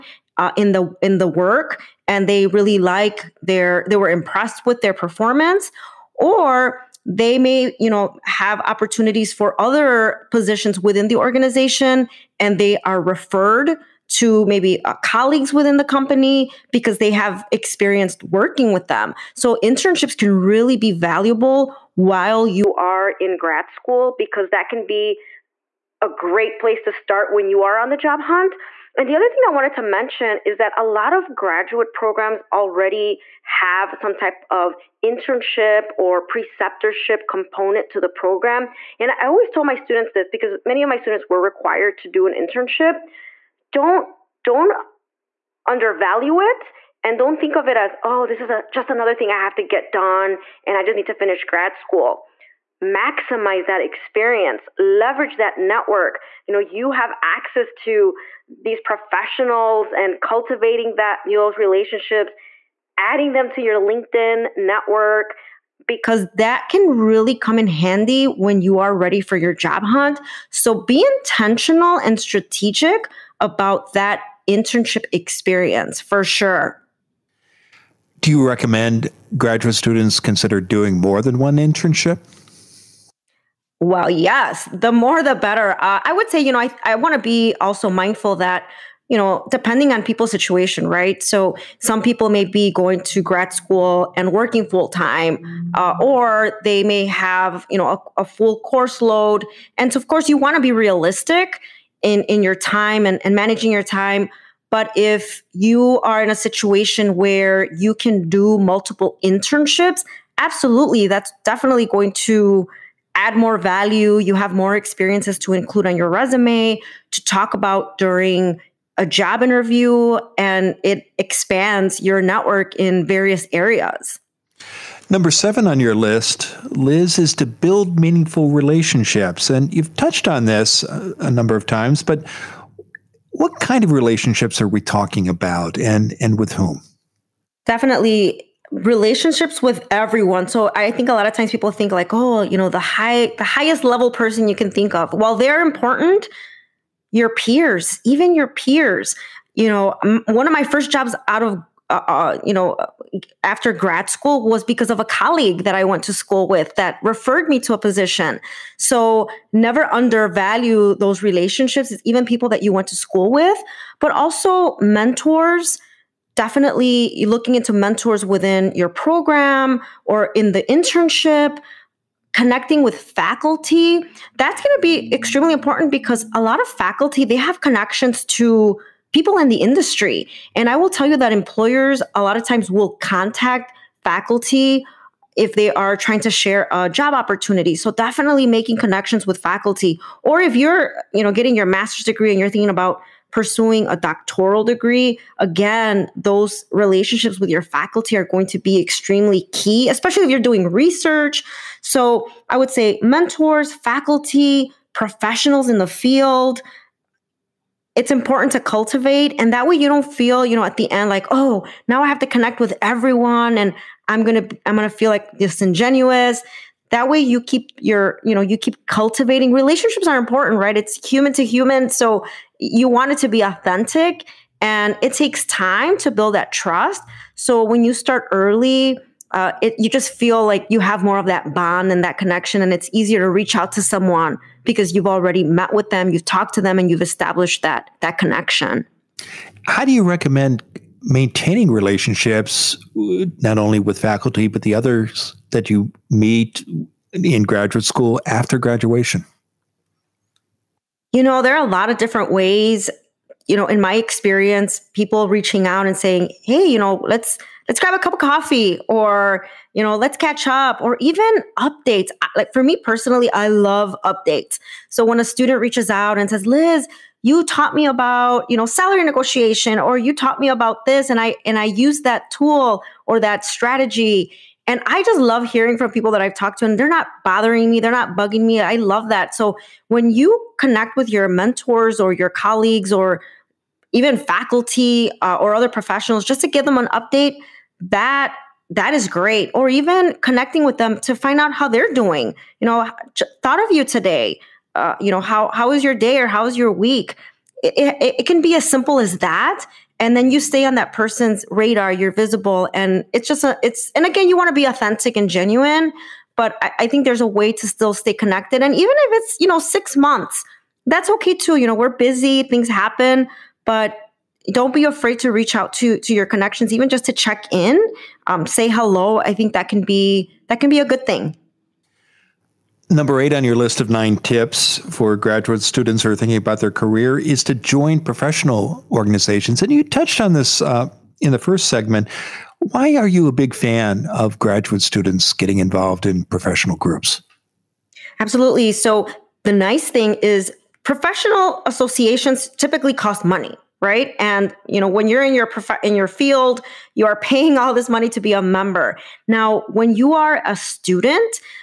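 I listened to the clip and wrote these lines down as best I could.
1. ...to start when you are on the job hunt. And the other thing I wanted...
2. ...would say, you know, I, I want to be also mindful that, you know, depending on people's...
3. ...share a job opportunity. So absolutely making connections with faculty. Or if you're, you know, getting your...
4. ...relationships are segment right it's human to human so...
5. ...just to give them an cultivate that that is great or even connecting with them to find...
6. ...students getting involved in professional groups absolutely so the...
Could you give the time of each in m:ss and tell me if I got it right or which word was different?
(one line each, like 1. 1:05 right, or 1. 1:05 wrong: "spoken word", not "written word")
1. 0:26 right
2. 1:26 right
3. 3:06 wrong: "definitely", not "absolutely"
4. 3:39 wrong: "important", not "segment"
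5. 4:46 wrong: "update", not "cultivate"
6. 5:34 right.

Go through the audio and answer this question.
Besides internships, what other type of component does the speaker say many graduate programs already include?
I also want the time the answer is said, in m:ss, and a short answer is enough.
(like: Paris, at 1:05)
Preceptorship, at 0:36.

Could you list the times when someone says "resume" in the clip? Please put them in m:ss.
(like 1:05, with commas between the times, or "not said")
1:56.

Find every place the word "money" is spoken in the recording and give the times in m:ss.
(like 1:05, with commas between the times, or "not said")
5:43, 5:47.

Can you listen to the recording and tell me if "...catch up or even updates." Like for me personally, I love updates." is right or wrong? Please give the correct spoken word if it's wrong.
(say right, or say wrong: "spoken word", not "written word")
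right.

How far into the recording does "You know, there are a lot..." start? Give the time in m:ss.
4:11.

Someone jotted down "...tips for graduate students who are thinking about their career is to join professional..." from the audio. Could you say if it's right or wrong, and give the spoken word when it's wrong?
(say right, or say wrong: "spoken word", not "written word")
right.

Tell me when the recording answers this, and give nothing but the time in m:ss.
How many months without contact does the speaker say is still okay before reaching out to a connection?
5:09.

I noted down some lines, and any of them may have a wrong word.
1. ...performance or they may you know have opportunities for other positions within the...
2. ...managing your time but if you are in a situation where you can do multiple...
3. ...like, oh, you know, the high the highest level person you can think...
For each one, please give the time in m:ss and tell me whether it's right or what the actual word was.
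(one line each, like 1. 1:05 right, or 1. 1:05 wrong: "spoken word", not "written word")
1. 0:04 right
2. 1:43 right
3. 2:21 right.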